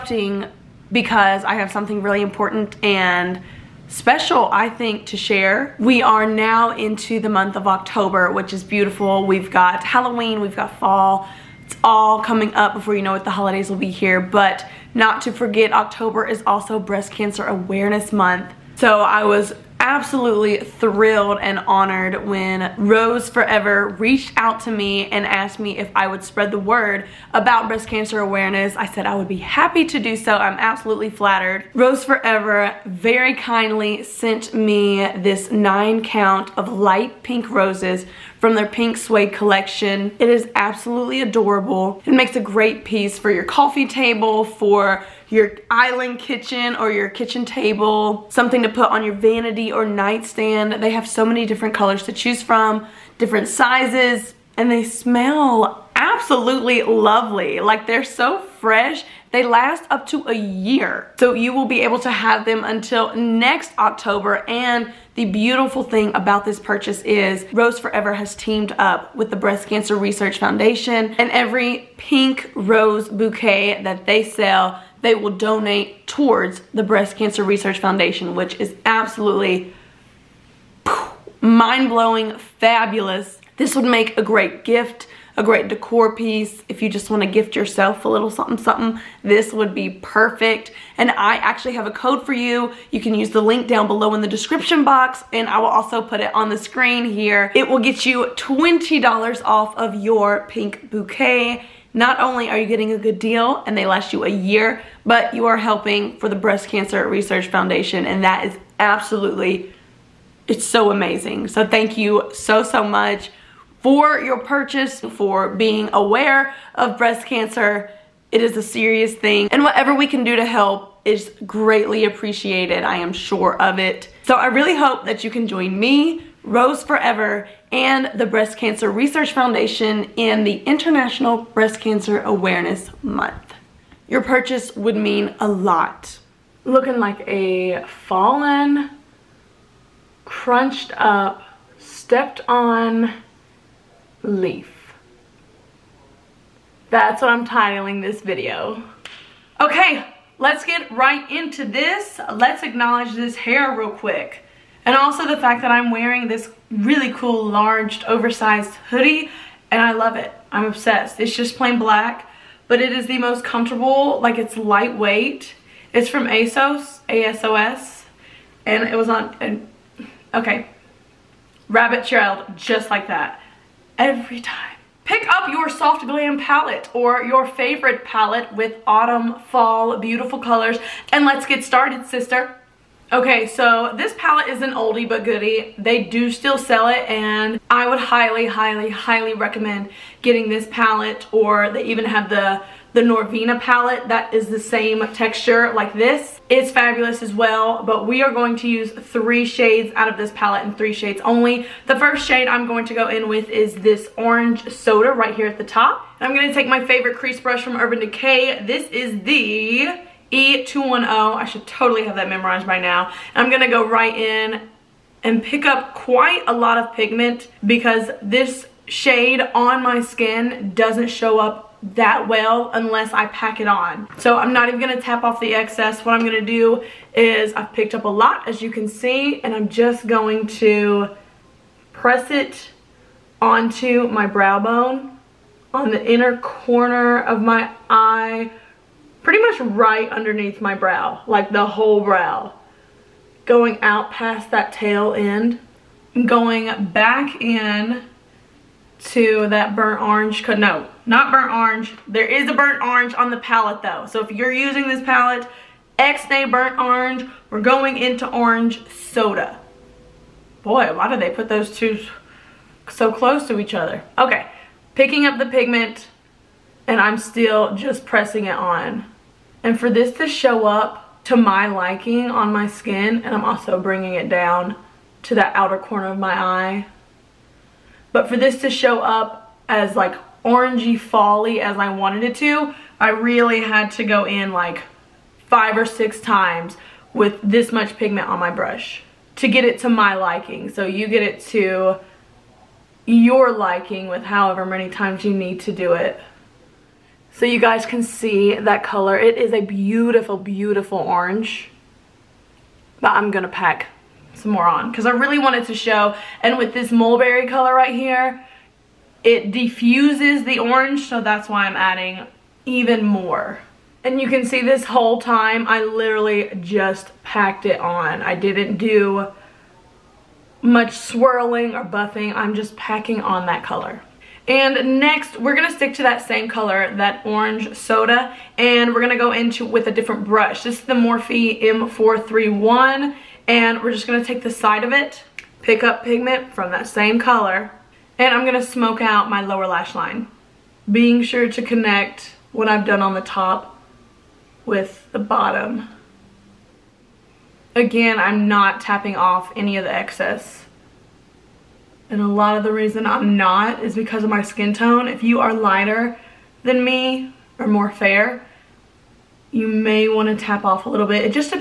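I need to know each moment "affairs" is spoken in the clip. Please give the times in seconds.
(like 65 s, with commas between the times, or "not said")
not said.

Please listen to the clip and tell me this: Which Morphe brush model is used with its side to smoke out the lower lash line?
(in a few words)
M431.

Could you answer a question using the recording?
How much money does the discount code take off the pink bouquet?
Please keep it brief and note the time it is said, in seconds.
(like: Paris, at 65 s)
$20, at 98 s.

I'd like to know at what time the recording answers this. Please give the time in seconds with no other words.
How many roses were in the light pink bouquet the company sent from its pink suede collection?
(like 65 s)
35 s.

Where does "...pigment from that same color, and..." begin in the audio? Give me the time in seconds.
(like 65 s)
336 s.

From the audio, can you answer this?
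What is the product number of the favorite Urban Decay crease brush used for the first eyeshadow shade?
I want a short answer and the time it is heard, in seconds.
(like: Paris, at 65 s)
E210, at 210 s.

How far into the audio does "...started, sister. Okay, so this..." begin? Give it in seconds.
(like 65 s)
181 s.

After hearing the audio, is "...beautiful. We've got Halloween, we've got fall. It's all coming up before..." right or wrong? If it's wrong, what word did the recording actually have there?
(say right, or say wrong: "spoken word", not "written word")
right.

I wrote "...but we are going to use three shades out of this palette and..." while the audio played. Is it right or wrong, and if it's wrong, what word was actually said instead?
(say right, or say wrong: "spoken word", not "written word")
right.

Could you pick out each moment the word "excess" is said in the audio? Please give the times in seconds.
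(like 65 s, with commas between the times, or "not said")
225 s, 349 s.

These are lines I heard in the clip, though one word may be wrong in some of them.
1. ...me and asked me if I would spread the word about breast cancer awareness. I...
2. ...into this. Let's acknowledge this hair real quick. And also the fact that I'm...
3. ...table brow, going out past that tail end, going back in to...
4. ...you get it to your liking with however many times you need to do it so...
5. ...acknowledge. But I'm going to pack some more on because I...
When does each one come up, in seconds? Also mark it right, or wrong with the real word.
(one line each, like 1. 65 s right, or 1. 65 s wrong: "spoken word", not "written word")
1. 24 s right
2. 151 s right
3. 241 s wrong: "whole", not "table"
4. 290 s right
5. 300 s wrong: "orange", not "acknowledge".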